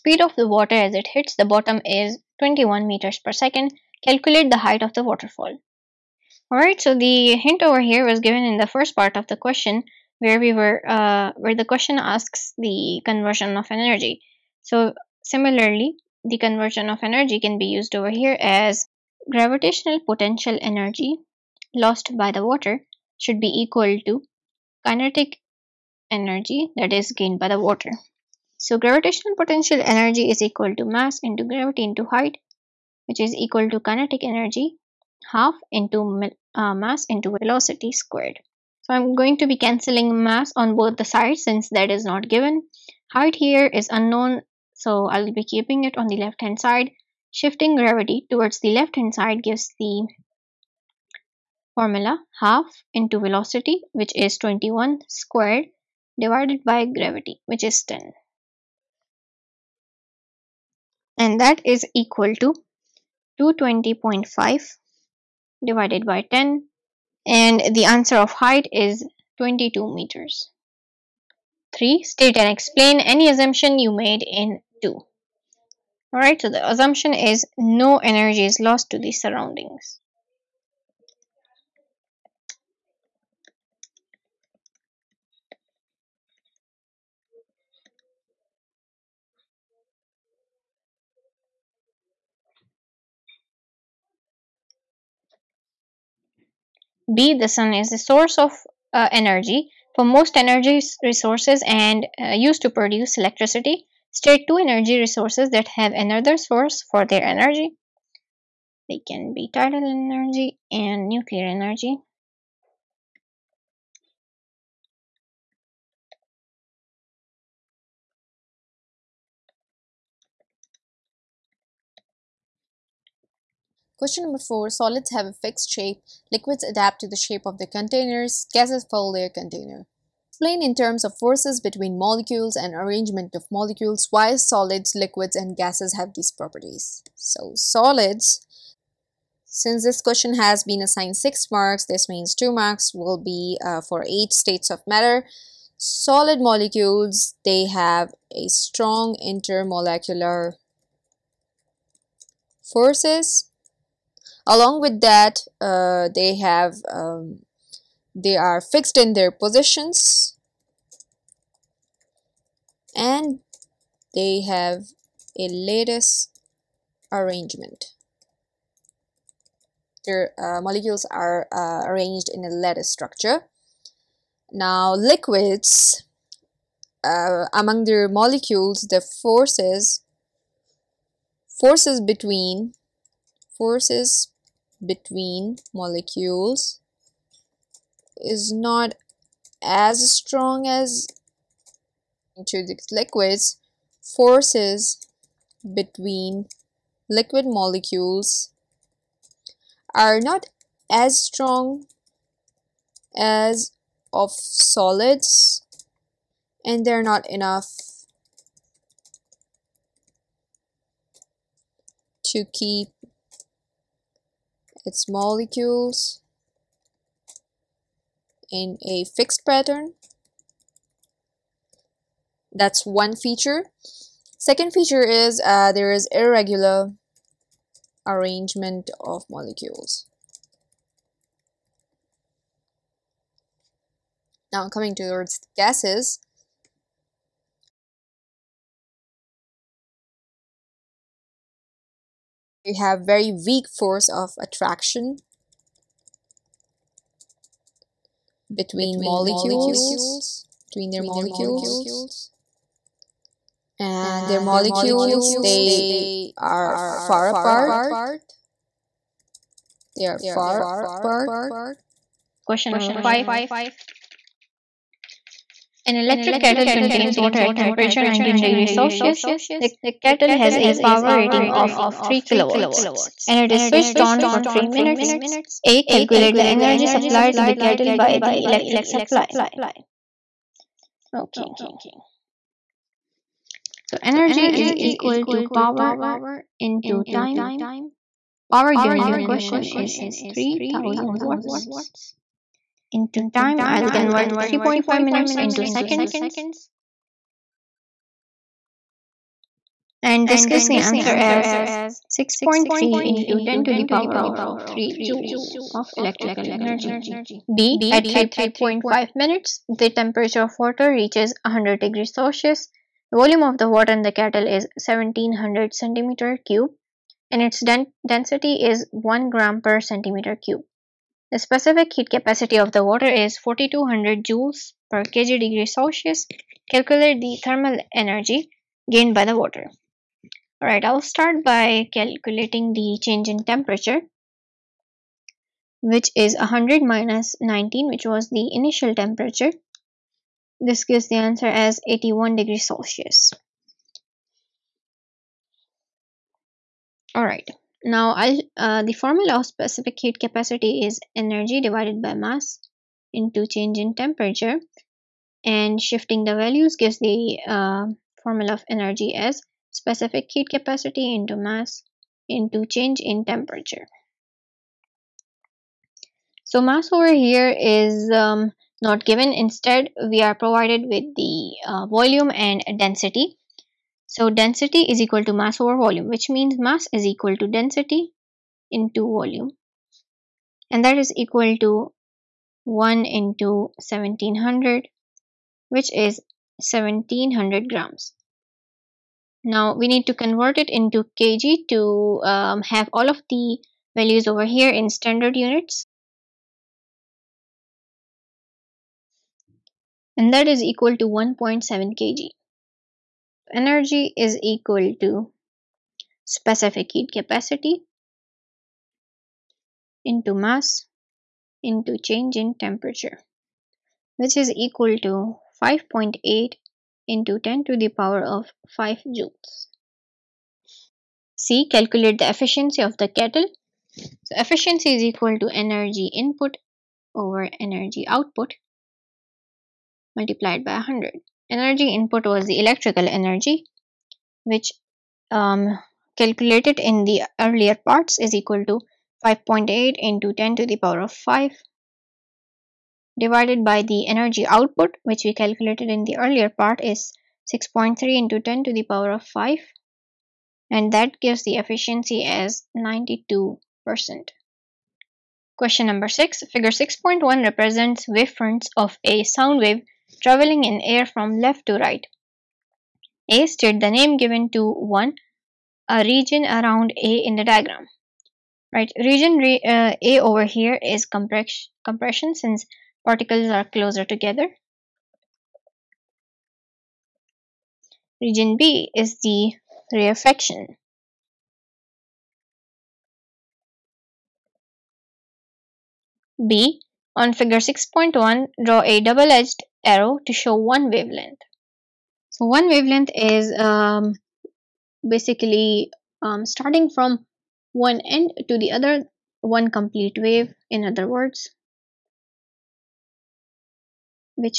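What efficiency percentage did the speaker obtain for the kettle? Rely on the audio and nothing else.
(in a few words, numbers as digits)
92%.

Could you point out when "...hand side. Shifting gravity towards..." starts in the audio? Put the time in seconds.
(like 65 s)
46 s.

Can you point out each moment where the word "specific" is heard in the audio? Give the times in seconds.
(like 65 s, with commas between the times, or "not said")
321 s, 349 s, 359 s, 406 s.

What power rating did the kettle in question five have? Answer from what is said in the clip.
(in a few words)
3 kilowatts.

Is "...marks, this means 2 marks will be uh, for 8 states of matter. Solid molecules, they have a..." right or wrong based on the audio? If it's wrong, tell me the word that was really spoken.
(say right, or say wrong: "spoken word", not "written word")
right.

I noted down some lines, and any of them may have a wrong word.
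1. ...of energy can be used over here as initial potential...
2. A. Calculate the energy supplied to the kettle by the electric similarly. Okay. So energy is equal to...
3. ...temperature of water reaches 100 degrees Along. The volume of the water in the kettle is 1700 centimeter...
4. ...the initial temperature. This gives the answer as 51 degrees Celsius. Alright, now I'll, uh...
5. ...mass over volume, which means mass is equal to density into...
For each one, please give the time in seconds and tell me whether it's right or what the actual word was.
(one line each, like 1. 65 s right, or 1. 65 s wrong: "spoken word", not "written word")
1. 16 s wrong: "gravitational", not "initial"
2. 275 s wrong: "supply", not "similarly"
3. 309 s wrong: "Celsius", not "Along"
4. 338 s wrong: "81", not "51"
5. 375 s right.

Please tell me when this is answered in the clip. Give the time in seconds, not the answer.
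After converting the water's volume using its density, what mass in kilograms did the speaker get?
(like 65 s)
401 s.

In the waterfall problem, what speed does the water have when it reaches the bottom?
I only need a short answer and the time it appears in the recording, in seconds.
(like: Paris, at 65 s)
21 meters per second, at 2 s.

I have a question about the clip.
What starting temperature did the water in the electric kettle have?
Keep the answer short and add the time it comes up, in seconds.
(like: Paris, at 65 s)
19 degrees Celsius, at 268 s.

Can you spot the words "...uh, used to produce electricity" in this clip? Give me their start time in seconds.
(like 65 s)
102 s.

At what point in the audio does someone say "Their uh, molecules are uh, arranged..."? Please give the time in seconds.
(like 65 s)
170 s.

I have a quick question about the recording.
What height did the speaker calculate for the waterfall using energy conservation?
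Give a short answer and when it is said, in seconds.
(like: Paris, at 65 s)
22 meters, at 69 s.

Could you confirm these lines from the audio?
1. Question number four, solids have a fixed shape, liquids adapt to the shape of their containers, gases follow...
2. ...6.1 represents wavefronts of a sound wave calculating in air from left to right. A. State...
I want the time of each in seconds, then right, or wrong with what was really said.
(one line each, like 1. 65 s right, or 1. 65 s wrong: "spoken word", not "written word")
1. 123 s right
2. 456 s wrong: "traveling", not "calculating".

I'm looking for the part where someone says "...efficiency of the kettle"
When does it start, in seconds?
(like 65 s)
422 s.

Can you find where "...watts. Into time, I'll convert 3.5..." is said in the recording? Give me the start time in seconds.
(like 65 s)
291 s.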